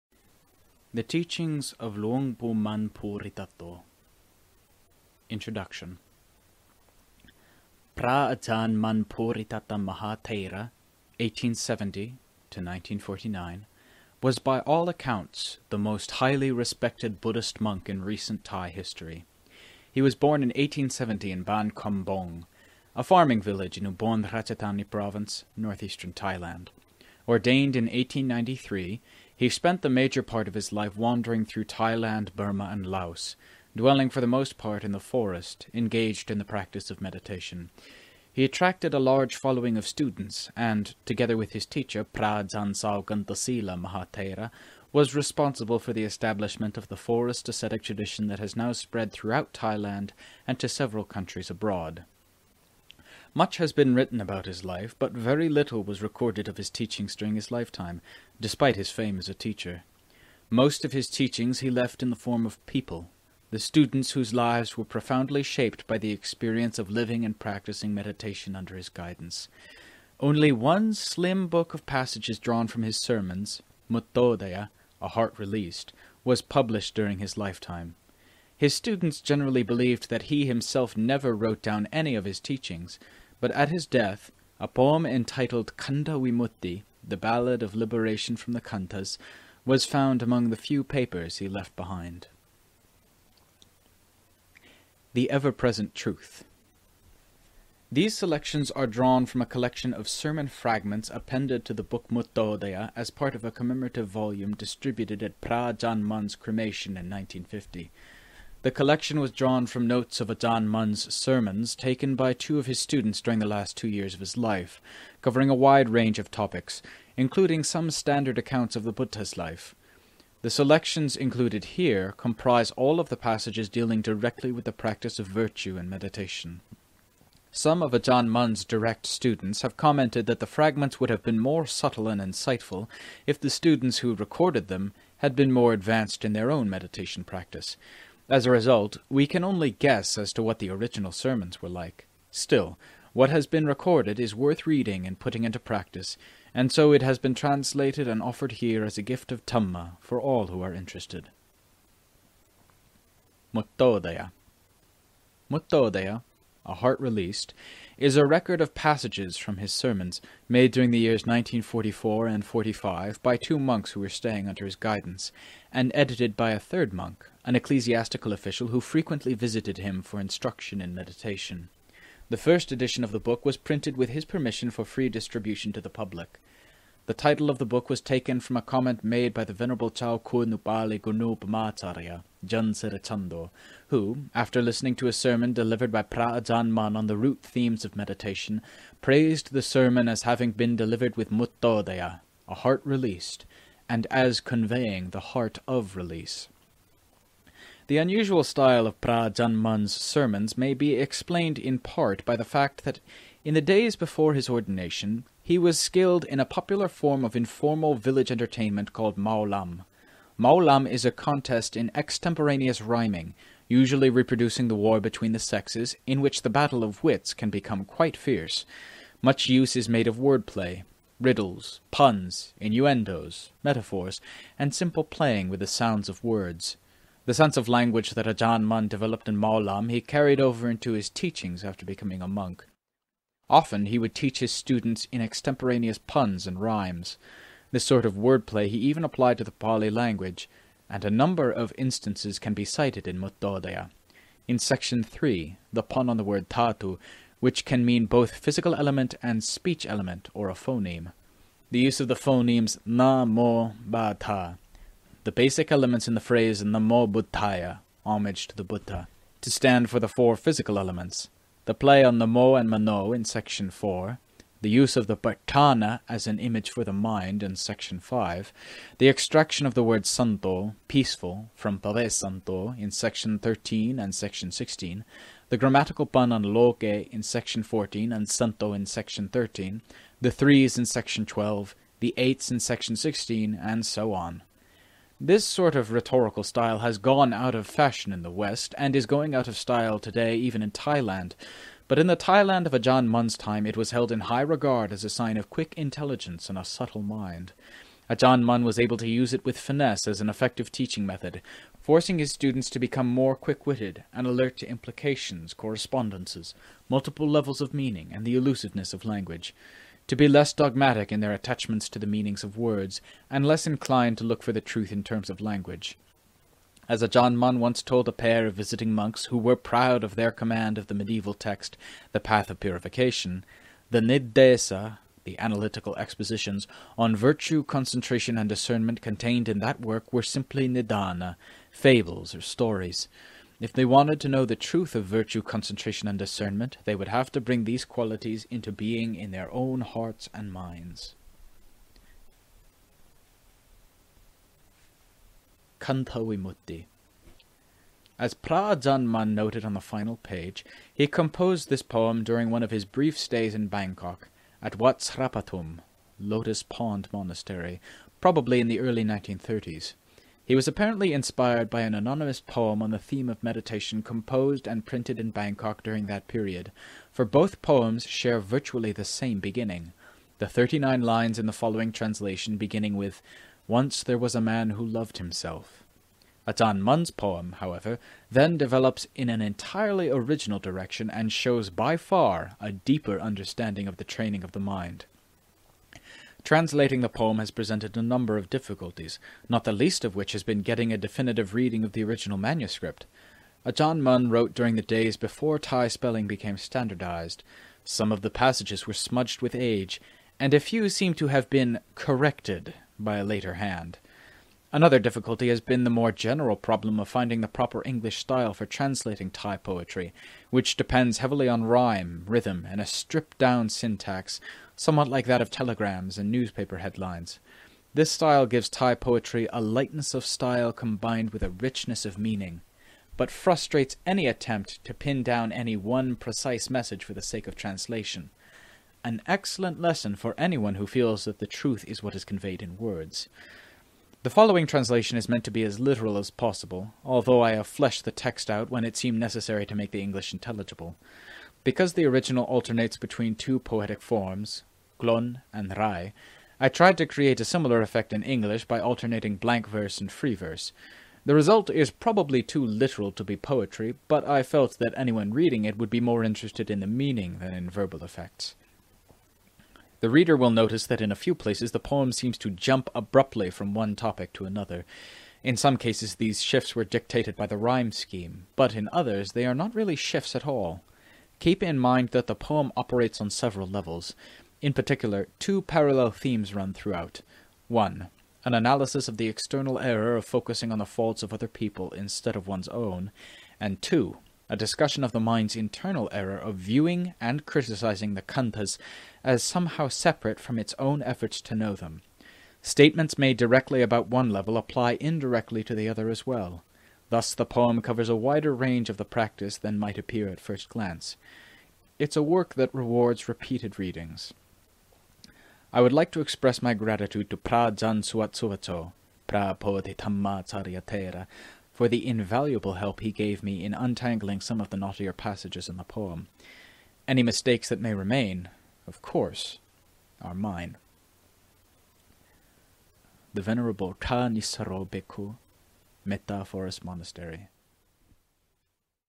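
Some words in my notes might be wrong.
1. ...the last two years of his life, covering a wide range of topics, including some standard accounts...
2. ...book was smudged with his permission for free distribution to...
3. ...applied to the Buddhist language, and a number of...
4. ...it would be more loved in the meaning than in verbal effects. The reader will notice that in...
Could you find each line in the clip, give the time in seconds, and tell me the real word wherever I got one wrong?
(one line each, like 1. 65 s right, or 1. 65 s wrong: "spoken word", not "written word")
1. 113 s right
2. 173 s wrong: "printed", not "smudged"
3. 239 s wrong: "Pali", not "Buddhist"
4. 455 s wrong: "interested", not "loved".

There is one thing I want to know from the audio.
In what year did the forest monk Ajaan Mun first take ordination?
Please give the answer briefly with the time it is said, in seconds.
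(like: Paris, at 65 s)
1893, at 27 s.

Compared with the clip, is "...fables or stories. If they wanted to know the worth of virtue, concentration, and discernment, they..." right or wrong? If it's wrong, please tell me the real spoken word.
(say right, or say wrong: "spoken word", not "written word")
wrong: "truth", not "worth".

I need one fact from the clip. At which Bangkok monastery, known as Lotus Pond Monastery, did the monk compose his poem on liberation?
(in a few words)
Wat Srapatum.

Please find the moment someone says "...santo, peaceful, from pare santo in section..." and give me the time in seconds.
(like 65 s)
270 s.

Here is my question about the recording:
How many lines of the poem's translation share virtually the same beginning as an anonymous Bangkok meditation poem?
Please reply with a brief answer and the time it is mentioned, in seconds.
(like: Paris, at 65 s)
39, at 370 s.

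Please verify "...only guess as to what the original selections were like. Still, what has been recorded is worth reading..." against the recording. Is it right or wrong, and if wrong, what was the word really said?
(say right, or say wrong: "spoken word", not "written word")
wrong: "sermons", not "selections".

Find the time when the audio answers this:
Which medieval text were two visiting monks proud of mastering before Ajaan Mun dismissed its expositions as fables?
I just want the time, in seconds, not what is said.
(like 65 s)
322 s.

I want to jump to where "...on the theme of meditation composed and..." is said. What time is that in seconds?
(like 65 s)
362 s.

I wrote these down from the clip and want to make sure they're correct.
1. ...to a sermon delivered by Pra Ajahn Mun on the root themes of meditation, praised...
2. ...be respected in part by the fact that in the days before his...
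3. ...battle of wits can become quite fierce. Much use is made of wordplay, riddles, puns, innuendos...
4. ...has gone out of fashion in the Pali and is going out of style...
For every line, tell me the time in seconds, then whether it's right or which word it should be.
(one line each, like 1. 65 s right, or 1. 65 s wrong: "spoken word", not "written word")
1. 184 s right
2. 200 s wrong: "explained", not "respected"
3. 216 s right
4. 286 s wrong: "West", not "Pali".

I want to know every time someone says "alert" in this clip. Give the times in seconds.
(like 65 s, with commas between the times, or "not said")
304 s.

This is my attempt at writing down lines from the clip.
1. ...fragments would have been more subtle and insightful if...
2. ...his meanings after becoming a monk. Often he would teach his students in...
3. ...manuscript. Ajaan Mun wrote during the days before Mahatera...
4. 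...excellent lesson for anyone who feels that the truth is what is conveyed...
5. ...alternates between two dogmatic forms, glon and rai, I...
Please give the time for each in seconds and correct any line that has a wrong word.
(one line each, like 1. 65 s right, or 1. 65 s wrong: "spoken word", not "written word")
1. 130 s right
2. 230 s wrong: "teachings", not "meanings"
3. 392 s wrong: "Thai", not "Mahatera"
4. 429 s right
5. 442 s wrong: "poetic", not "dogmatic".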